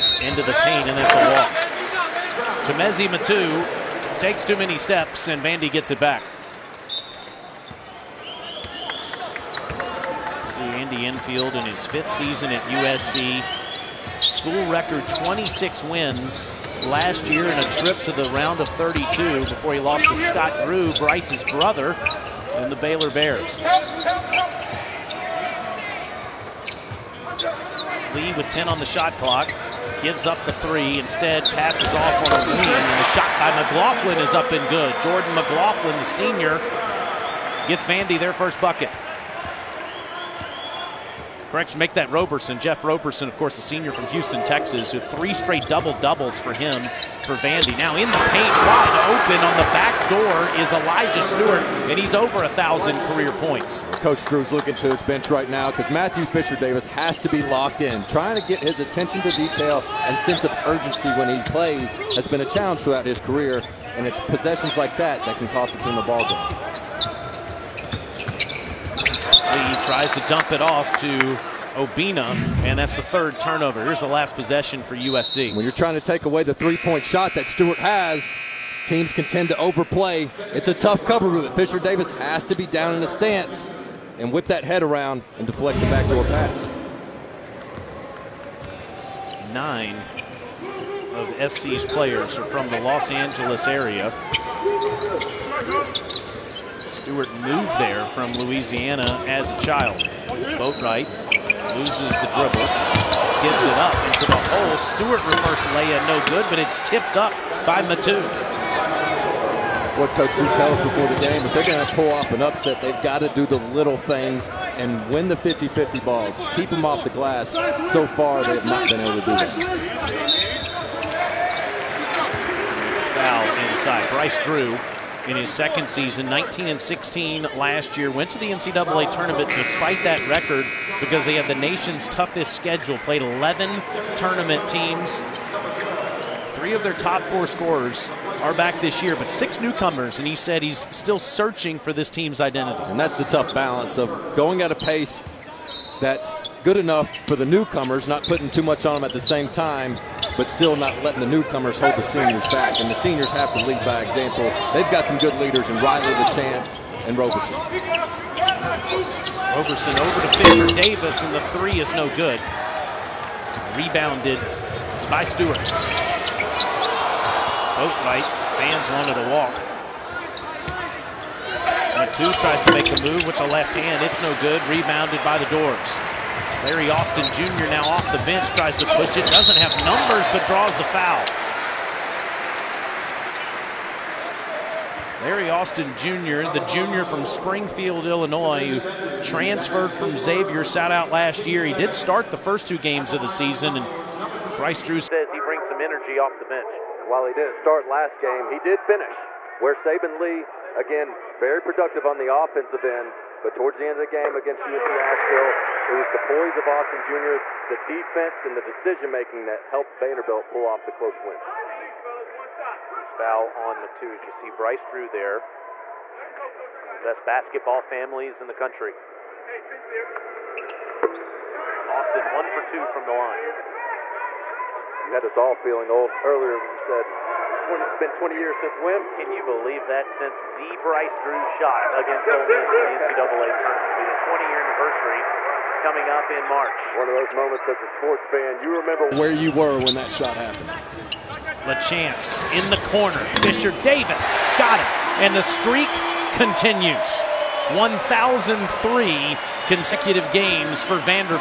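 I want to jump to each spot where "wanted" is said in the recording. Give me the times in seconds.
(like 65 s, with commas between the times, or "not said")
168 s.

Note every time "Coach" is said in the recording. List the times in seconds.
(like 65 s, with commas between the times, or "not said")
54 s, 110 s.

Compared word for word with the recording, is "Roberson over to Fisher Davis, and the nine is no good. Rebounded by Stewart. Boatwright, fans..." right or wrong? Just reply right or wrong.
wrong.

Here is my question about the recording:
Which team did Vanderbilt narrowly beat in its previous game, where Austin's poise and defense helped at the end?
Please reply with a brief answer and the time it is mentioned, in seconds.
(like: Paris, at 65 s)
UNC Asheville, at 204 s.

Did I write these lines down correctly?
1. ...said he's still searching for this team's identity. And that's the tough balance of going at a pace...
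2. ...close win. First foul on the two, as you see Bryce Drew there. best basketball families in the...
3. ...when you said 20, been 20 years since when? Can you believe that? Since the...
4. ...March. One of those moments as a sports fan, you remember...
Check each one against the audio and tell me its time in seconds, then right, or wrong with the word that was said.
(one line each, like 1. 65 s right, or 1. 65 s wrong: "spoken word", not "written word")
1. 140 s right
2. 210 s right
3. 226 s right
4. 236 s right.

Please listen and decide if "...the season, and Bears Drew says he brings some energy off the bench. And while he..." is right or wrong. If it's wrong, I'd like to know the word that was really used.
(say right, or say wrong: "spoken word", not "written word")
wrong: "Bryce", not "Bears".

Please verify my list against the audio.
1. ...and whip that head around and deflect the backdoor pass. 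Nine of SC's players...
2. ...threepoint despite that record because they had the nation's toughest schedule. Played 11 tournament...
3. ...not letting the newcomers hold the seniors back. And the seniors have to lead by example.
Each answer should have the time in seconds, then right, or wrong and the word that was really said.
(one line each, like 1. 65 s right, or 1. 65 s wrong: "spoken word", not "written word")
1. 84 s right
2. 129 s wrong: "tournament", not "threepoint"
3. 150 s right.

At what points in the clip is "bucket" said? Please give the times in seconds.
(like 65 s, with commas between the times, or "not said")
38 s.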